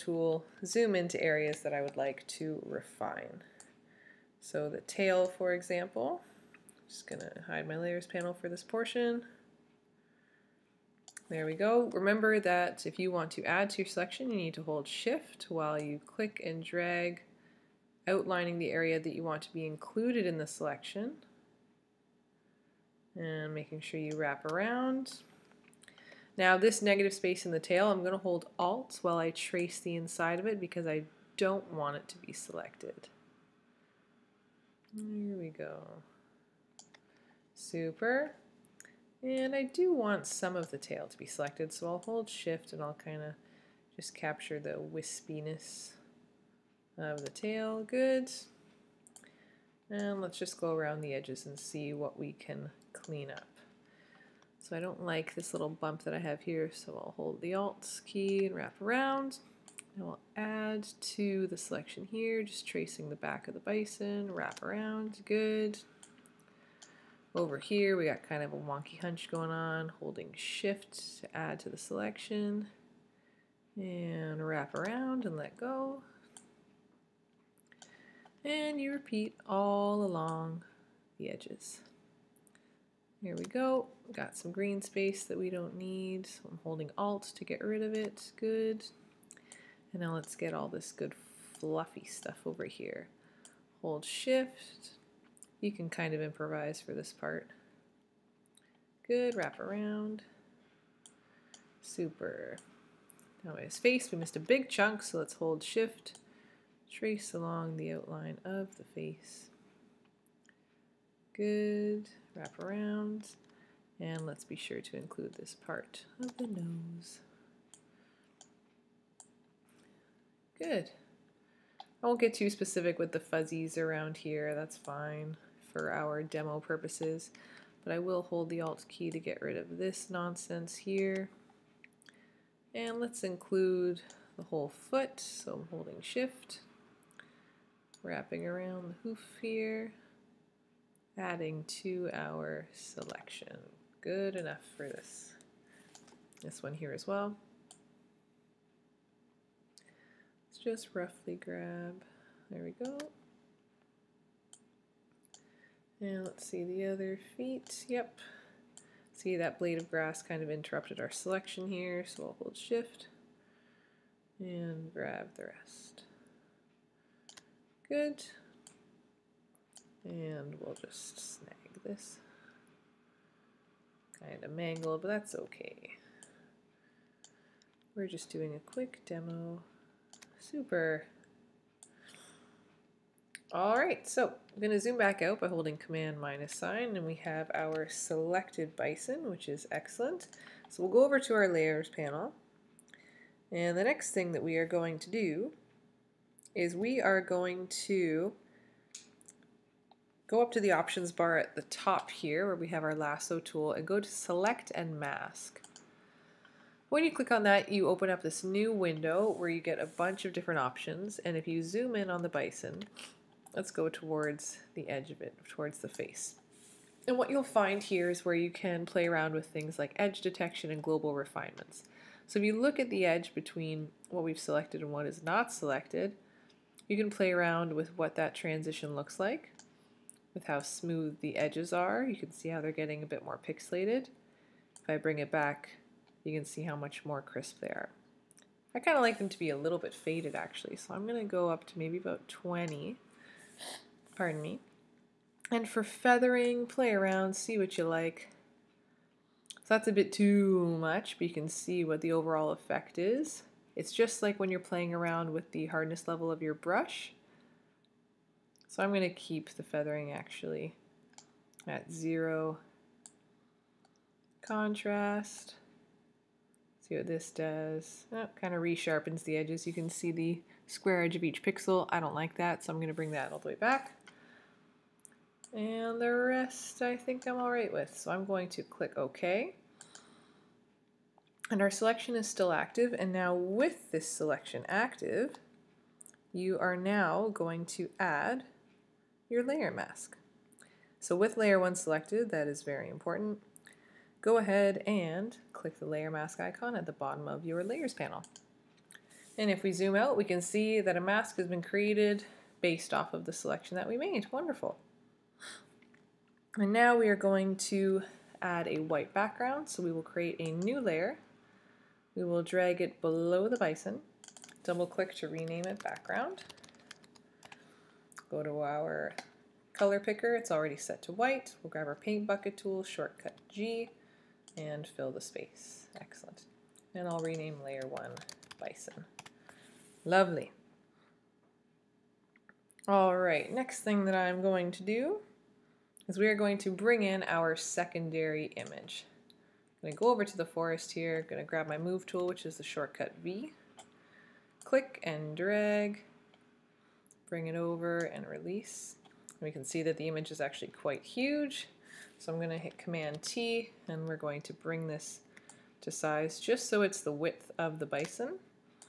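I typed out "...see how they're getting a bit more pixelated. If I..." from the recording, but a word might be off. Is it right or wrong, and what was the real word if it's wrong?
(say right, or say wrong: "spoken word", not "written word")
right.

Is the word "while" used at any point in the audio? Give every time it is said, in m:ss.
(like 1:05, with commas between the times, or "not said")
0:15, 0:29.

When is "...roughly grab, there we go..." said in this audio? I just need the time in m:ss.
2:30.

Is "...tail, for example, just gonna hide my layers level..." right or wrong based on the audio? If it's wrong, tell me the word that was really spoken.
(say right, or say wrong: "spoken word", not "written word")
wrong: "panel", not "level".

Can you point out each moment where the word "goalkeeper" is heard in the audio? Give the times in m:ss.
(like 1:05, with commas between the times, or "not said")
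not said.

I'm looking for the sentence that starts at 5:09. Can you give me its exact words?
So we will create a new layer.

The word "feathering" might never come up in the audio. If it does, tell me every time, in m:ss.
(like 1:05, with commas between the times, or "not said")
4:05, 4:19.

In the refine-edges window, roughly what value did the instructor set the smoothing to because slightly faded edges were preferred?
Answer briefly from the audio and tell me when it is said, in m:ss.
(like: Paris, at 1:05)
20, at 4:02.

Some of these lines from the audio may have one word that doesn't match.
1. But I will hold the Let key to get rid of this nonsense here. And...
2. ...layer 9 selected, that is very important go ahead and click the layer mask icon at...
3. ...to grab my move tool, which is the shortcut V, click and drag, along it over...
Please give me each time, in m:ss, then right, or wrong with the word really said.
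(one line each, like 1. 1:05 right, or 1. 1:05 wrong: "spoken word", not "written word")
1. 2:07 wrong: "Alt", not "Let"
2. 4:51 wrong: "1", not "9"
3. 5:41 wrong: "bring", not "along".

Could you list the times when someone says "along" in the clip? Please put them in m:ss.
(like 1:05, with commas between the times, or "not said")
1:20, 1:47.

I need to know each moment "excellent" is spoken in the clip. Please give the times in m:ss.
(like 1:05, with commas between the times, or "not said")
3:09, 5:26.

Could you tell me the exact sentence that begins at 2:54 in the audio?
Kind of mangle, but that's okay.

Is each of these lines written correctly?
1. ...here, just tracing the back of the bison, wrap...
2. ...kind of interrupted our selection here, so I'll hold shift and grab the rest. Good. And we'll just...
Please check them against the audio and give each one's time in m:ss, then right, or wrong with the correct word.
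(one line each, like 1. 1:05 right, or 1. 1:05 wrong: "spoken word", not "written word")
1. 1:02 right
2. 2:40 right.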